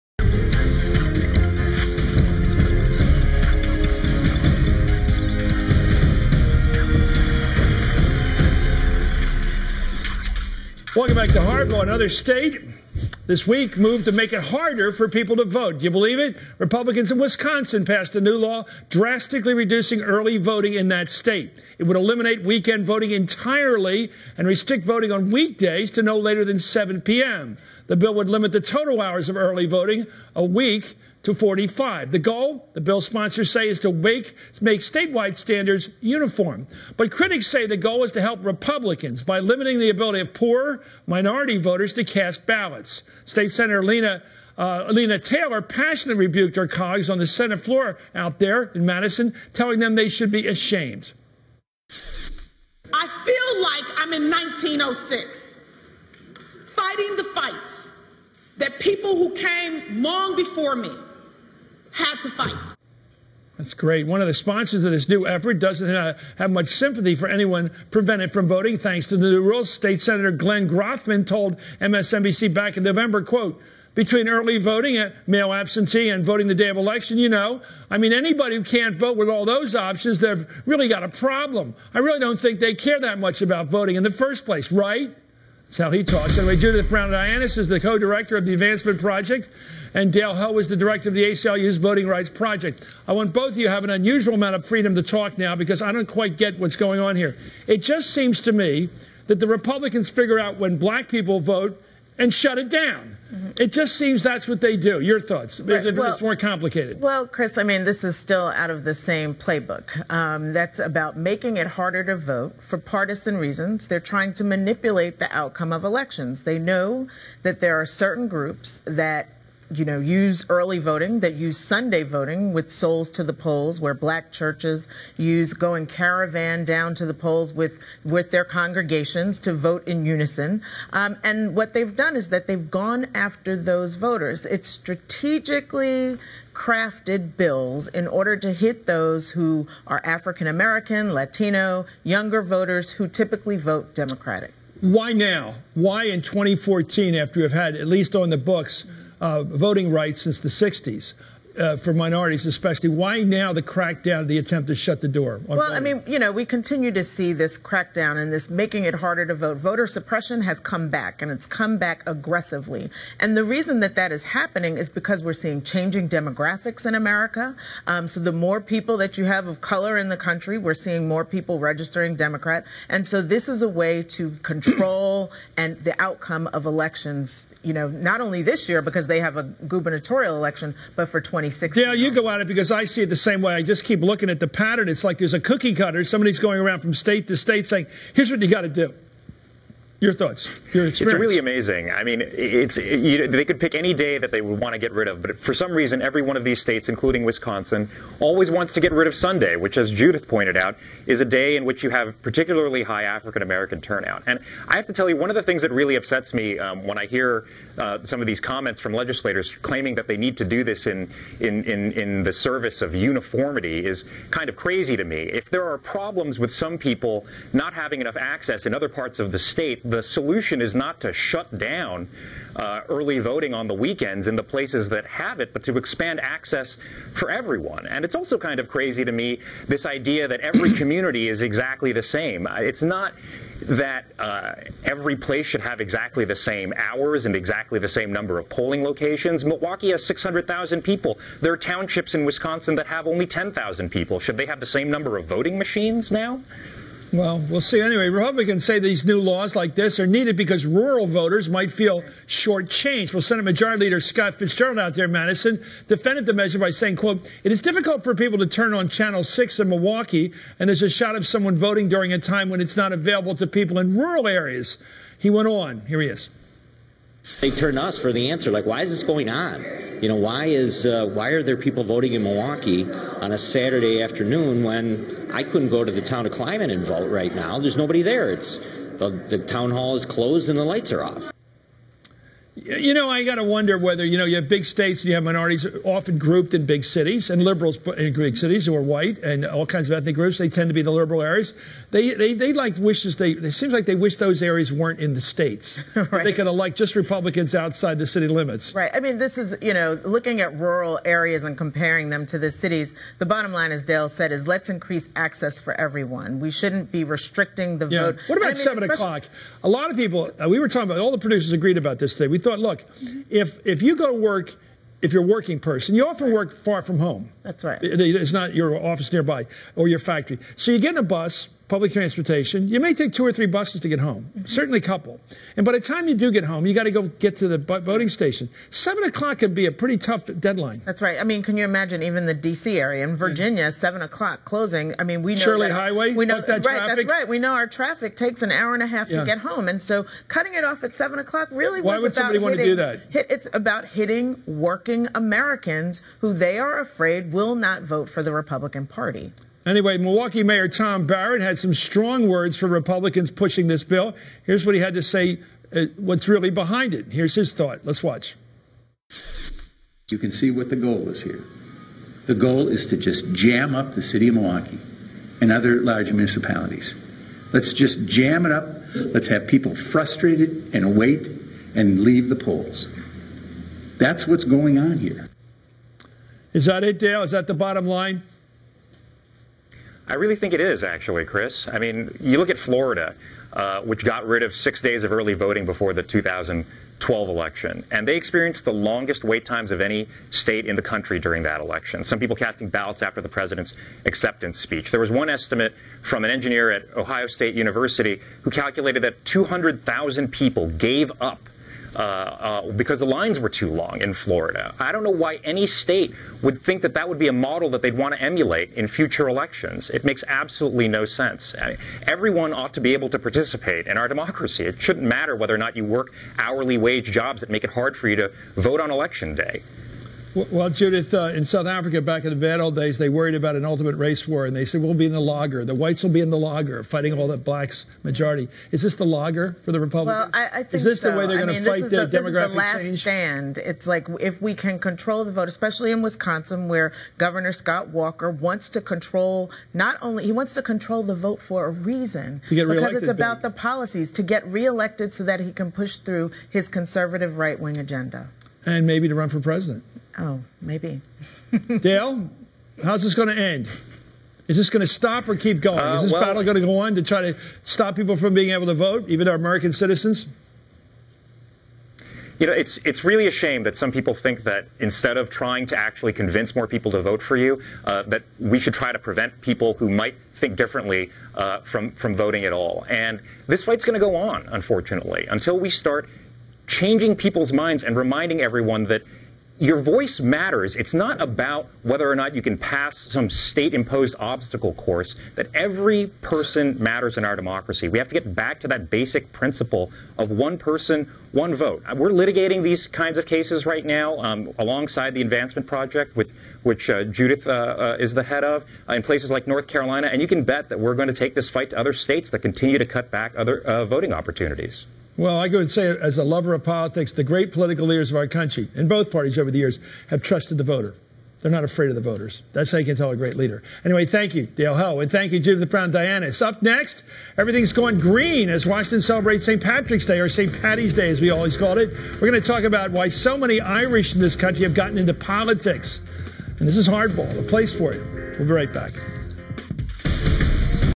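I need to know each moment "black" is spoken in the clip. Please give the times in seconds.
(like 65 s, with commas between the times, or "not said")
100 s, 123 s, 427 s.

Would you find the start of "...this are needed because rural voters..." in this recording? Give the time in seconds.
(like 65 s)
249 s.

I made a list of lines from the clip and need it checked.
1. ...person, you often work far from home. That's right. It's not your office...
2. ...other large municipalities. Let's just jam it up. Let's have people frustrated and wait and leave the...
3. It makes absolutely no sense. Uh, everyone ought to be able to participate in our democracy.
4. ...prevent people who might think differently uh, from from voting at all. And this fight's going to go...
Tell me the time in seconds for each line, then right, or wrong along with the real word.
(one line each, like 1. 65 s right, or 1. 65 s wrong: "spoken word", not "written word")
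1. 315 s right
2. 365 s right
3. 409 s right
4. 468 s right.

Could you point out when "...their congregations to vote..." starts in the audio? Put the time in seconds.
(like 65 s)
128 s.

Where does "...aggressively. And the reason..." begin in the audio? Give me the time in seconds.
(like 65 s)
162 s.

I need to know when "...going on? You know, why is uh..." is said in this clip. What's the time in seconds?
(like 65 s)
269 s.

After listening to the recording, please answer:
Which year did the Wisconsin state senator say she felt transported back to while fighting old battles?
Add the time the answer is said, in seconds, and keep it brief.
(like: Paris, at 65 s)
1906, at 54 s.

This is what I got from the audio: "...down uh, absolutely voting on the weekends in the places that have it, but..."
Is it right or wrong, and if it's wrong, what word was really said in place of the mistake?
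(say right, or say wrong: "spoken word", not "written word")
wrong: "early", not "absolutely".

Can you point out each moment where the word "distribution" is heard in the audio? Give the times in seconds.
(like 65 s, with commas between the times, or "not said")
not said.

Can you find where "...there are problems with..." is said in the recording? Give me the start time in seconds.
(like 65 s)
215 s.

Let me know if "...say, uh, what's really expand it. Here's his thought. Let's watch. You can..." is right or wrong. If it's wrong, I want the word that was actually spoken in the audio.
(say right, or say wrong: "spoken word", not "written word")
wrong: "behind", not "expand".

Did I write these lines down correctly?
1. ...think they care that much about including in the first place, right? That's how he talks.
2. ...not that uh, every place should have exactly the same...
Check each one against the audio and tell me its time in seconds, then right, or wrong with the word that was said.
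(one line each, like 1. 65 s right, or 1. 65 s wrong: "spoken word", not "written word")
1. 82 s wrong: "voting", not "including"
2. 232 s right.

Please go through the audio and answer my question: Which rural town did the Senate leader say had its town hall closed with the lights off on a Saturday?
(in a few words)
Clyman.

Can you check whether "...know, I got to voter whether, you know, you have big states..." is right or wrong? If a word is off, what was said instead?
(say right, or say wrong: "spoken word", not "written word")
wrong: "wonder", not "voter".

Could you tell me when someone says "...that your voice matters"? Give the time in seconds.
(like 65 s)
478 s.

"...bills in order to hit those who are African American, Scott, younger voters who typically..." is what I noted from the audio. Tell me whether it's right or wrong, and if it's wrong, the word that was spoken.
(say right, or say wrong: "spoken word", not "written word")
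wrong: "Latino", not "Scott".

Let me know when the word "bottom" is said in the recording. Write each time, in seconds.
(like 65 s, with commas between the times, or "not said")
303 s, 377 s.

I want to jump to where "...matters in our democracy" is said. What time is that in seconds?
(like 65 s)
486 s.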